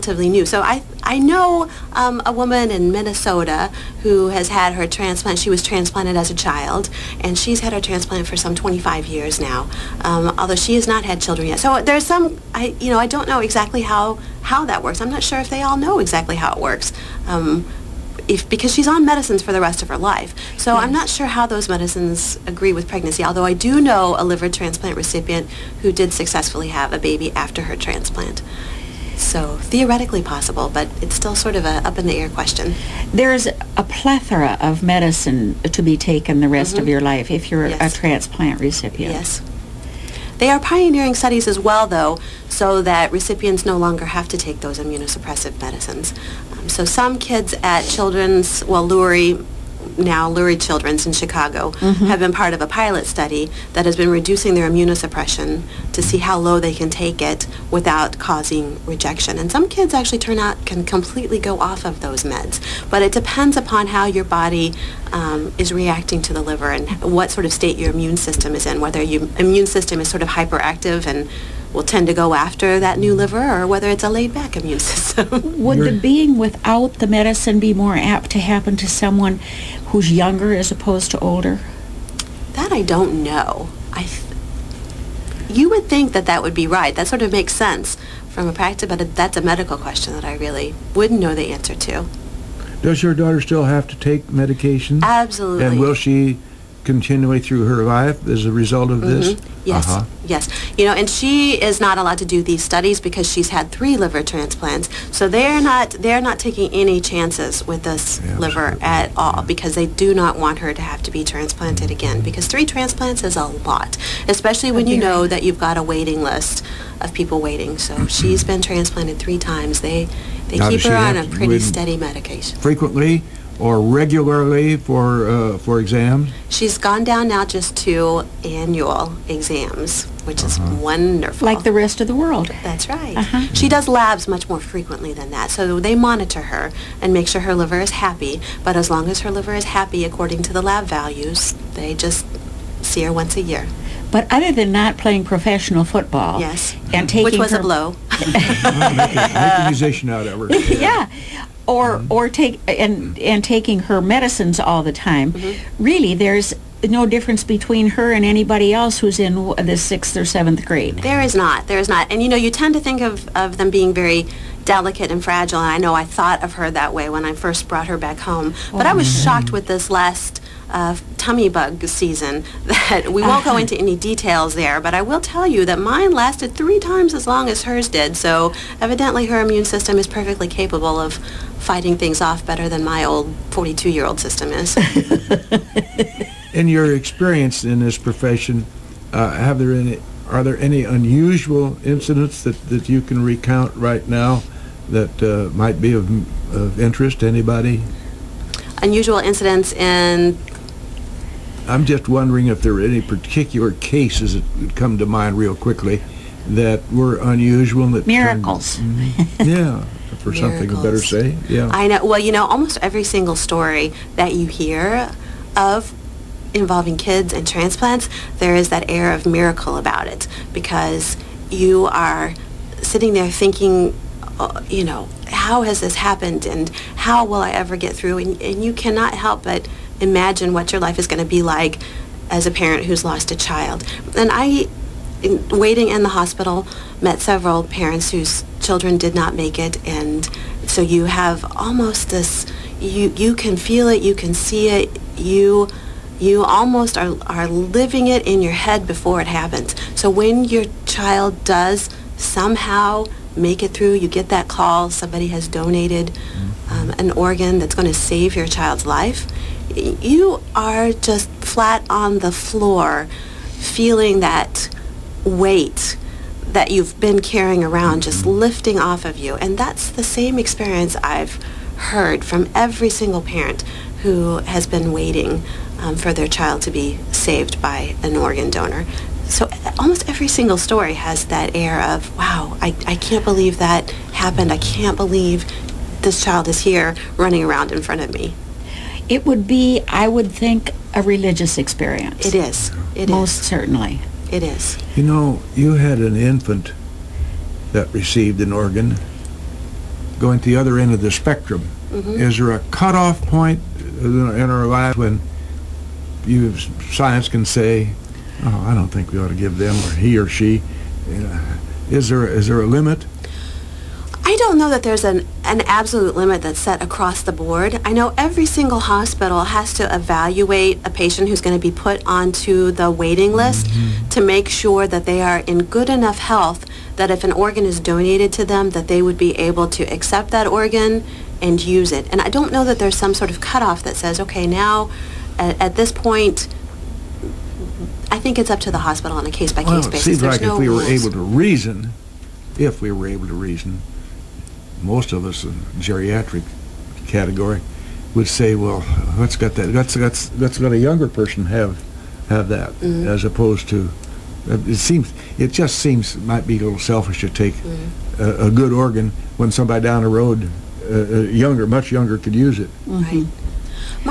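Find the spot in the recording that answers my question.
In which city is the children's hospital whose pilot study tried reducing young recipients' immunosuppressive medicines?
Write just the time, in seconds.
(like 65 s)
51 s.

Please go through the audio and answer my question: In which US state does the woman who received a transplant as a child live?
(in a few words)
Minnesota.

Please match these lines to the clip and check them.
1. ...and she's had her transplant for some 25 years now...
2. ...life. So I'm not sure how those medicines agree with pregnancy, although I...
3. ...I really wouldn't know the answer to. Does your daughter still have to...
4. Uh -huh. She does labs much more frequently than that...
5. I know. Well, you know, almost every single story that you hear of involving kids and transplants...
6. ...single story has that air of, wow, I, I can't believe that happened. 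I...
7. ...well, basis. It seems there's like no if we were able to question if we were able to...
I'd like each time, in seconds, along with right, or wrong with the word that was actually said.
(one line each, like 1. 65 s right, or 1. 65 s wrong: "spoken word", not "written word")
1. 7 s right
2. 19 s right
3. 90 s right
4. 133 s right
5. 211 s right
6. 280 s right
7. 339 s wrong: "reason", not "question".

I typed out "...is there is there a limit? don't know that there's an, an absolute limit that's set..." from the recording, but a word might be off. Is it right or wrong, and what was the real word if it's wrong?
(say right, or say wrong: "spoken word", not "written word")
right.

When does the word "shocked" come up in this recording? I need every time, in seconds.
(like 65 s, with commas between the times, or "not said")
169 s.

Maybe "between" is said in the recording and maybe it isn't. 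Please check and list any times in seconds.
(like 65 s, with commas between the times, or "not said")
157 s.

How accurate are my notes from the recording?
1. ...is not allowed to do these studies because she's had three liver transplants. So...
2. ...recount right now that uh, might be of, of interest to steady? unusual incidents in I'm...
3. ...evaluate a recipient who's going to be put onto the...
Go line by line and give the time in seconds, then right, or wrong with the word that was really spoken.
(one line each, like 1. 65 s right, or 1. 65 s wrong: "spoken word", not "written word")
1. 101 s right
2. 193 s wrong: "anybody", not "steady"
3. 319 s wrong: "patient", not "recipient".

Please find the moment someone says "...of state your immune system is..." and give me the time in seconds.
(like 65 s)
67 s.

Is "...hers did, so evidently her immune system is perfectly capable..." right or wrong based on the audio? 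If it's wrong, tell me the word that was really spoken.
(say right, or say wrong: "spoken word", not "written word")
right.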